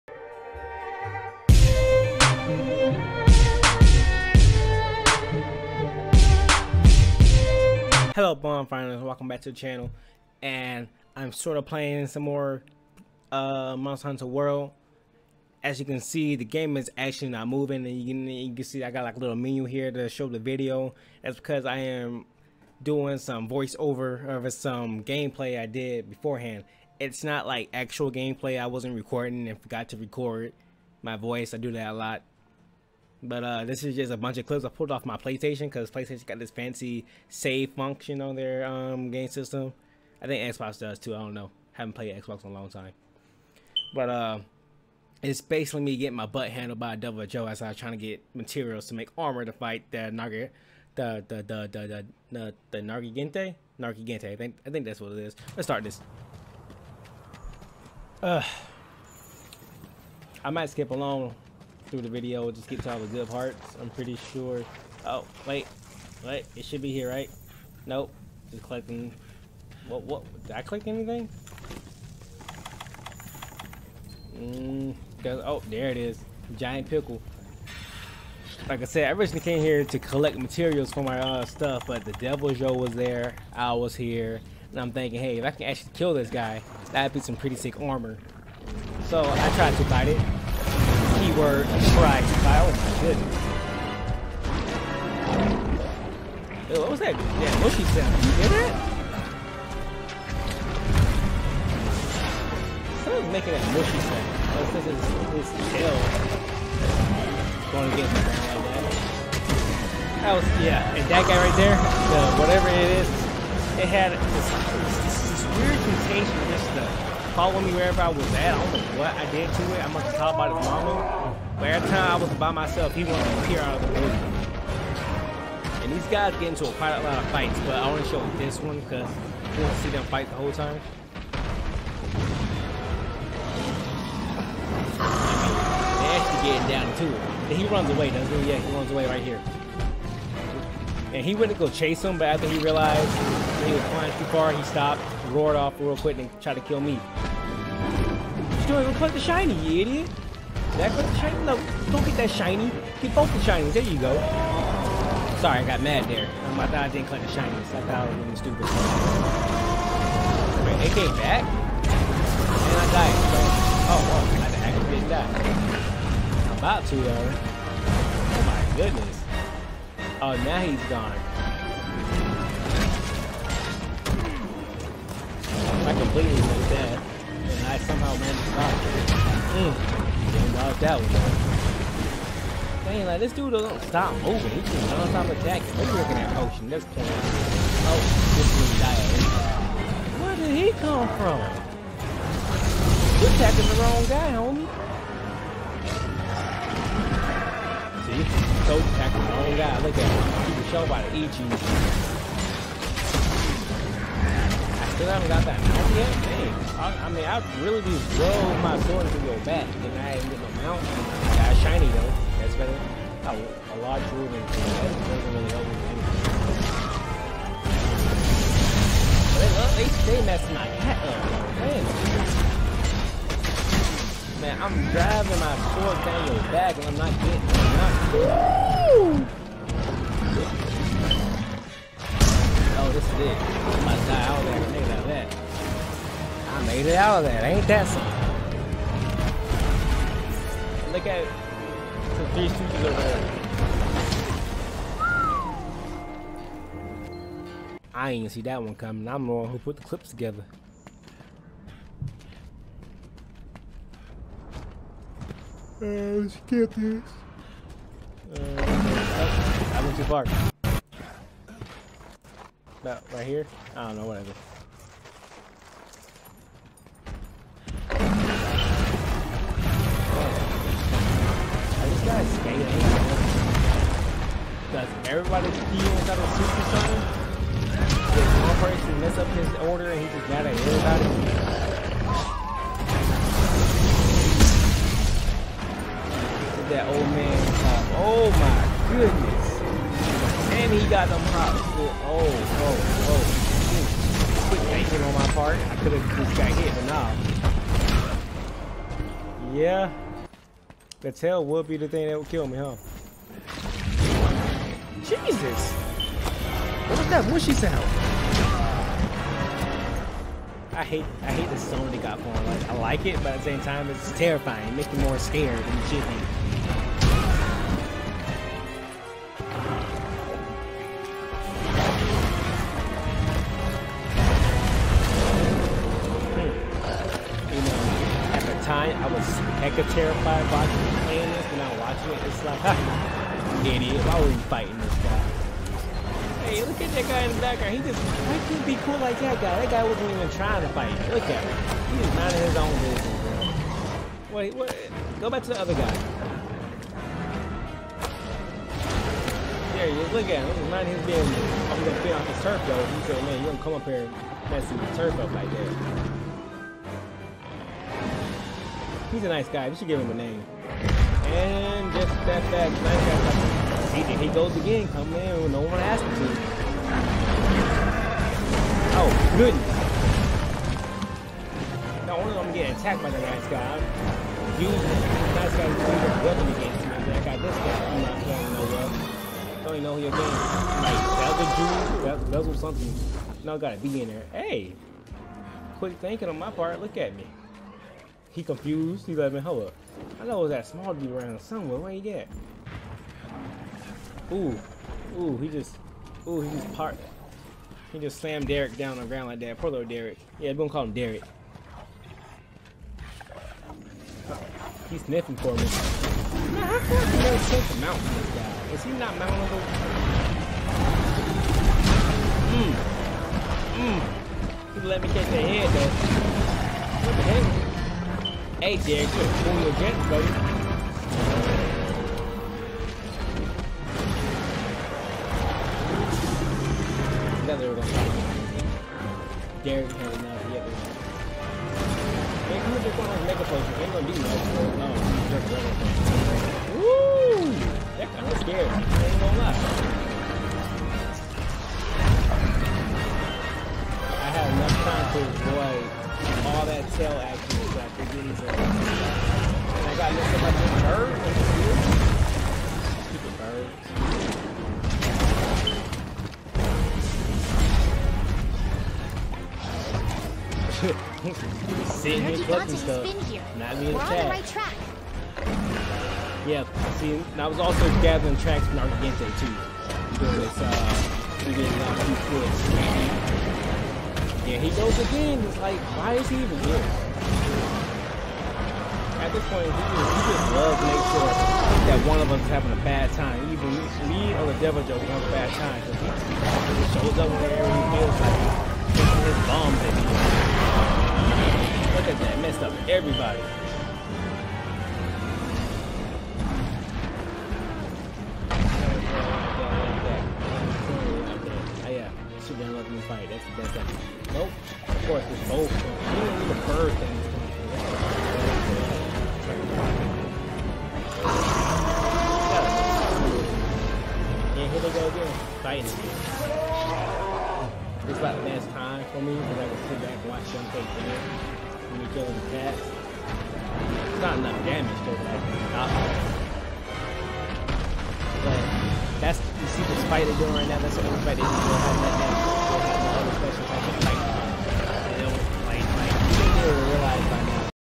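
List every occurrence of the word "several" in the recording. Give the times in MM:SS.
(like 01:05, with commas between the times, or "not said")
not said.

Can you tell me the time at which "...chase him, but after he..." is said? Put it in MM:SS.
02:21.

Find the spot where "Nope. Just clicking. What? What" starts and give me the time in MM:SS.
01:07.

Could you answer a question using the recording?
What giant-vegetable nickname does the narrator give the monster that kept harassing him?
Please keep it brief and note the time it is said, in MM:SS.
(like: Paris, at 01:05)
Giant pickle, at 01:16.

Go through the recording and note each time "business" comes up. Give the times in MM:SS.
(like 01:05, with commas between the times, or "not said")
05:42, 05:51.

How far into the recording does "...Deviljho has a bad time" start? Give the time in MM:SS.
08:04.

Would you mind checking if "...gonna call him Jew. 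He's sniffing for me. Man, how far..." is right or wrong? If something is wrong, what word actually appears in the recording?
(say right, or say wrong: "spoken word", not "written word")
wrong: "Derek", not "Jew".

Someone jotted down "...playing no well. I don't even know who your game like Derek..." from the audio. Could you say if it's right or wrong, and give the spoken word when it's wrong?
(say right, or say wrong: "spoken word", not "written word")
wrong: "Belzer", not "Derek".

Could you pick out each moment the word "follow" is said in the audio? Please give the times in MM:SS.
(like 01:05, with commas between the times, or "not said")
01:57.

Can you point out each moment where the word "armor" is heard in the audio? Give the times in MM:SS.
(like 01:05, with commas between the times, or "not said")
00:49, 01:27.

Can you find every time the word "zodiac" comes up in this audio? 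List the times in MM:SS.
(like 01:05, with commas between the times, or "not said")
not said.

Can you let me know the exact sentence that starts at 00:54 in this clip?
I think I think that's what it is.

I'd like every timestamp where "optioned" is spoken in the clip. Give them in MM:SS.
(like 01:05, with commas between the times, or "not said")
not said.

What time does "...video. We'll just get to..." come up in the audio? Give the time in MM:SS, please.
01:02.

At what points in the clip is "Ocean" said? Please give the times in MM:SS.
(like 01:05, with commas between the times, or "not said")
03:06.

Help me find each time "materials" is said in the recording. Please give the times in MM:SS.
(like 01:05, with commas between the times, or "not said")
00:48, 01:20.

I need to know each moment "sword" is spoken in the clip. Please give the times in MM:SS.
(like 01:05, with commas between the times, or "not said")
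03:28, 03:45.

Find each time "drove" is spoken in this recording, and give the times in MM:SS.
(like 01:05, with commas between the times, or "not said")
03:28.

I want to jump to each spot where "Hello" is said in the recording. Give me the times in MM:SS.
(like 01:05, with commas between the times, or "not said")
00:08.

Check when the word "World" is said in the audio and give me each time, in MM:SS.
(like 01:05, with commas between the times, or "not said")
00:14.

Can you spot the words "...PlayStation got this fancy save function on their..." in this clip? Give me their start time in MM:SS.
00:35.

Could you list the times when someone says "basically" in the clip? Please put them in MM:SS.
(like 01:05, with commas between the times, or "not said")
00:45.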